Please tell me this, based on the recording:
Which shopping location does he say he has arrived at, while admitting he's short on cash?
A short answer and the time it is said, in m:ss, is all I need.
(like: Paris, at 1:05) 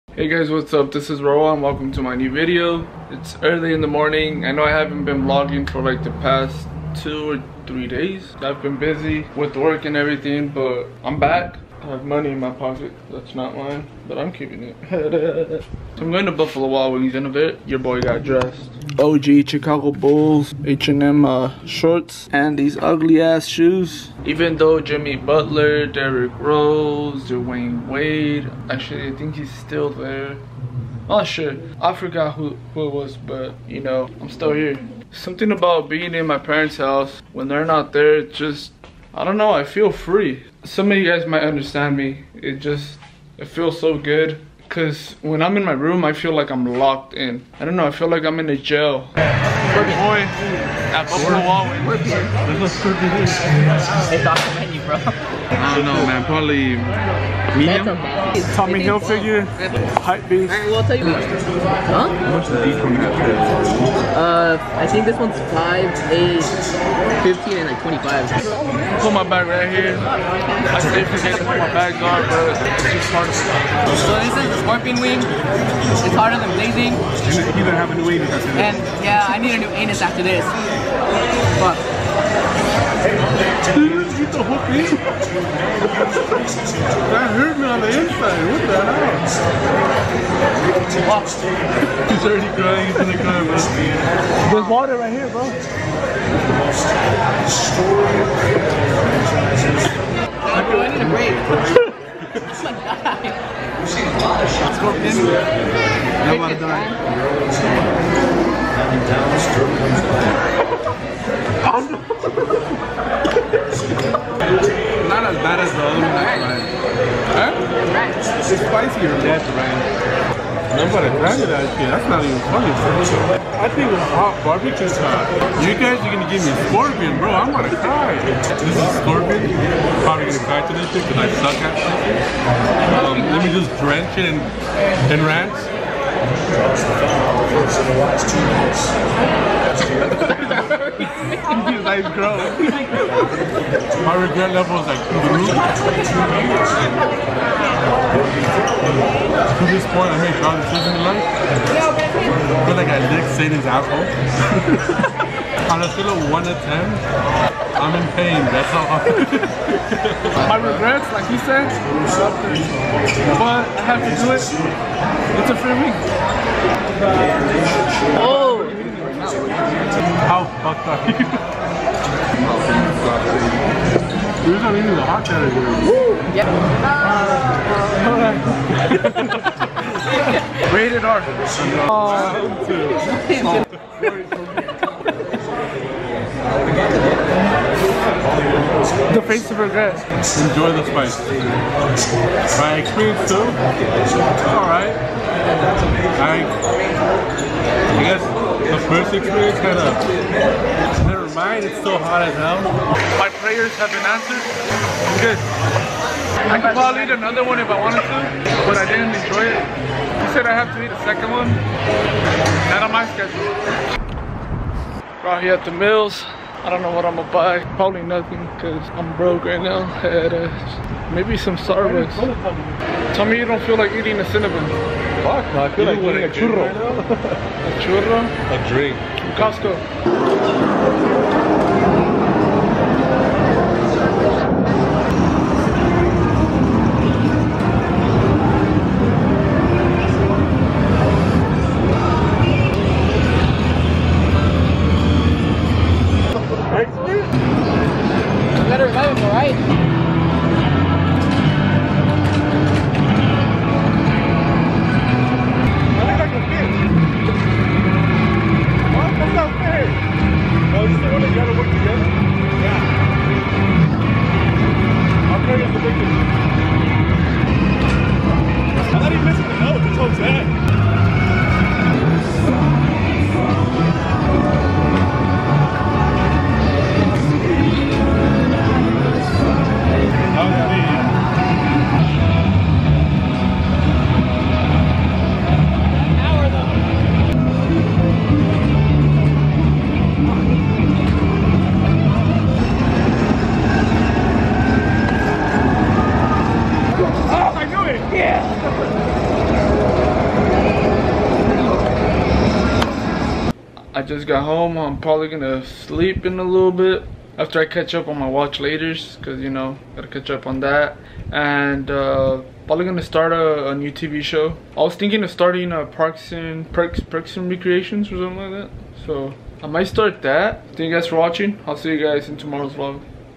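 The Mills, at 3:35.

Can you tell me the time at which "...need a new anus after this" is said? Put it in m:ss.
1:19.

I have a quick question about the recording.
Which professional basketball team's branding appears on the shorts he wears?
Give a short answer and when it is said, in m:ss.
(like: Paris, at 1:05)
Chicago Bulls, at 0:19.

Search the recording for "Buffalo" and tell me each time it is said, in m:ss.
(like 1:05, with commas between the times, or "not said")
0:16, 0:51.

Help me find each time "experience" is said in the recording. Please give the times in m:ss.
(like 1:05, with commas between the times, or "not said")
3:12, 3:19.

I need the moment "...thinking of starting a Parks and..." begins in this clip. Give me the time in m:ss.
5:14.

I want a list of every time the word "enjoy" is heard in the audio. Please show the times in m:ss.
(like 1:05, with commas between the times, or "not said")
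3:10, 3:29.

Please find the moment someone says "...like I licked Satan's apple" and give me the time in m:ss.
2:32.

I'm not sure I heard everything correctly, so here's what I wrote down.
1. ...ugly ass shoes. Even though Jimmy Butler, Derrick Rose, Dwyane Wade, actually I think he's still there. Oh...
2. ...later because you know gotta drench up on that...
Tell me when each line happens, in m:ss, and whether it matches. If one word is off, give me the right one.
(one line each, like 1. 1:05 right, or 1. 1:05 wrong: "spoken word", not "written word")
1. 0:22 right
2. 5:08 wrong: "catch", not "drench".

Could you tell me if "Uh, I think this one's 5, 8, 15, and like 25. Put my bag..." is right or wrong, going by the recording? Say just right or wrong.
right.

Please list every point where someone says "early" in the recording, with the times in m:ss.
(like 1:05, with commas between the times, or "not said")
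0:03.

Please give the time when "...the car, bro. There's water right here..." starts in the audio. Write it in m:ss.
1:33.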